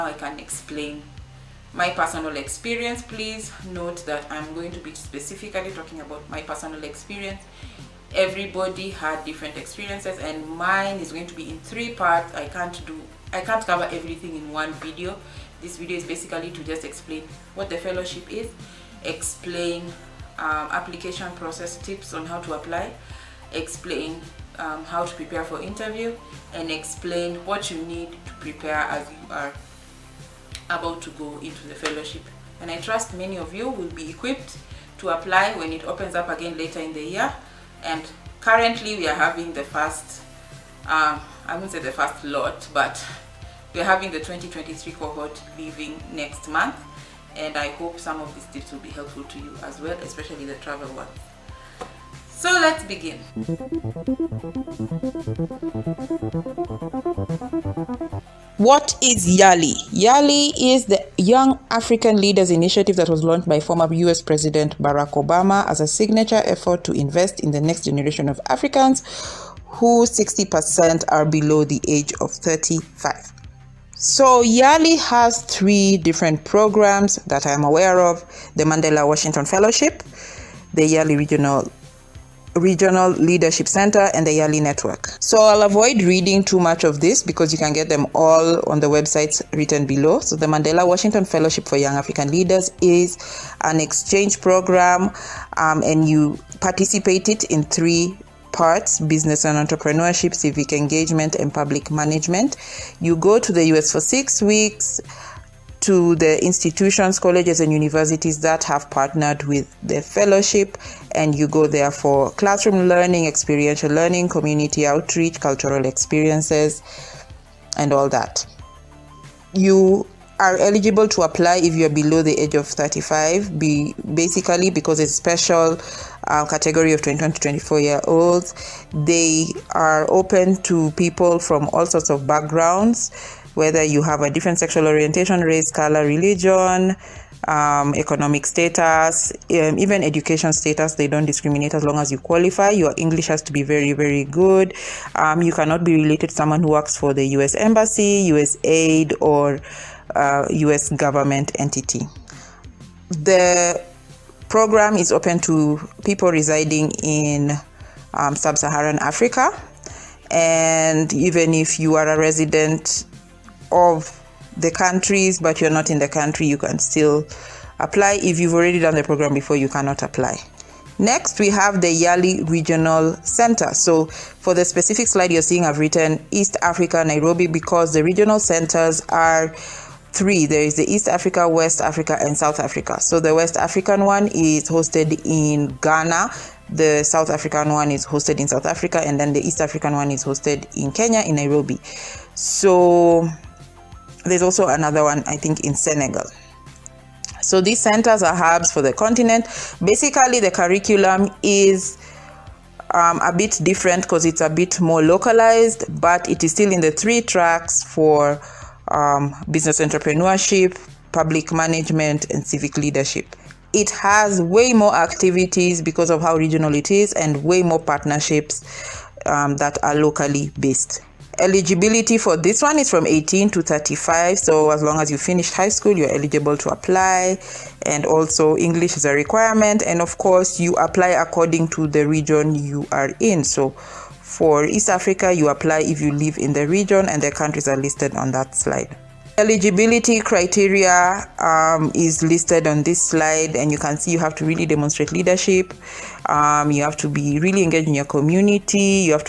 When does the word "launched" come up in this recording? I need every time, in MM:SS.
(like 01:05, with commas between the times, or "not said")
01:03.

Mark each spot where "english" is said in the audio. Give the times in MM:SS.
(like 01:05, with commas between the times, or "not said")
02:22, 03:48.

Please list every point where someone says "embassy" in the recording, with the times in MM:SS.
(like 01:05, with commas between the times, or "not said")
02:27.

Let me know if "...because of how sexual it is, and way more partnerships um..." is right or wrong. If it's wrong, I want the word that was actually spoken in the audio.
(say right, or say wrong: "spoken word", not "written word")
wrong: "regional", not "sexual".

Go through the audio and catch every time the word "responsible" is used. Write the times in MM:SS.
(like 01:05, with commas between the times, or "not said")
not said.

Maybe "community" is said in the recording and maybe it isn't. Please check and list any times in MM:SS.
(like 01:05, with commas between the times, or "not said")
01:54, 04:08.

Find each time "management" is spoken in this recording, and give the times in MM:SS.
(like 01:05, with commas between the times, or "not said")
01:41, 03:31.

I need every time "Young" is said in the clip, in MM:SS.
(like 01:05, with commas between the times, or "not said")
01:01, 01:31.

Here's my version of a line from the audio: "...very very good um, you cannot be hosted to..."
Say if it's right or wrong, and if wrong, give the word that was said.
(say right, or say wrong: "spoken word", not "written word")
wrong: "related", not "hosted".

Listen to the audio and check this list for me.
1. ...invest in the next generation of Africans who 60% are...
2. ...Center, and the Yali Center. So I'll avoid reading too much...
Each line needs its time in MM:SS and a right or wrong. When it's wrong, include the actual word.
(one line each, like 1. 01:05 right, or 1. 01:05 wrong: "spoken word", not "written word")
1. 01:06 right
2. 01:23 wrong: "Network", not "Center".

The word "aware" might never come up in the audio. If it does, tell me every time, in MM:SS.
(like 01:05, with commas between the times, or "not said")
01:17.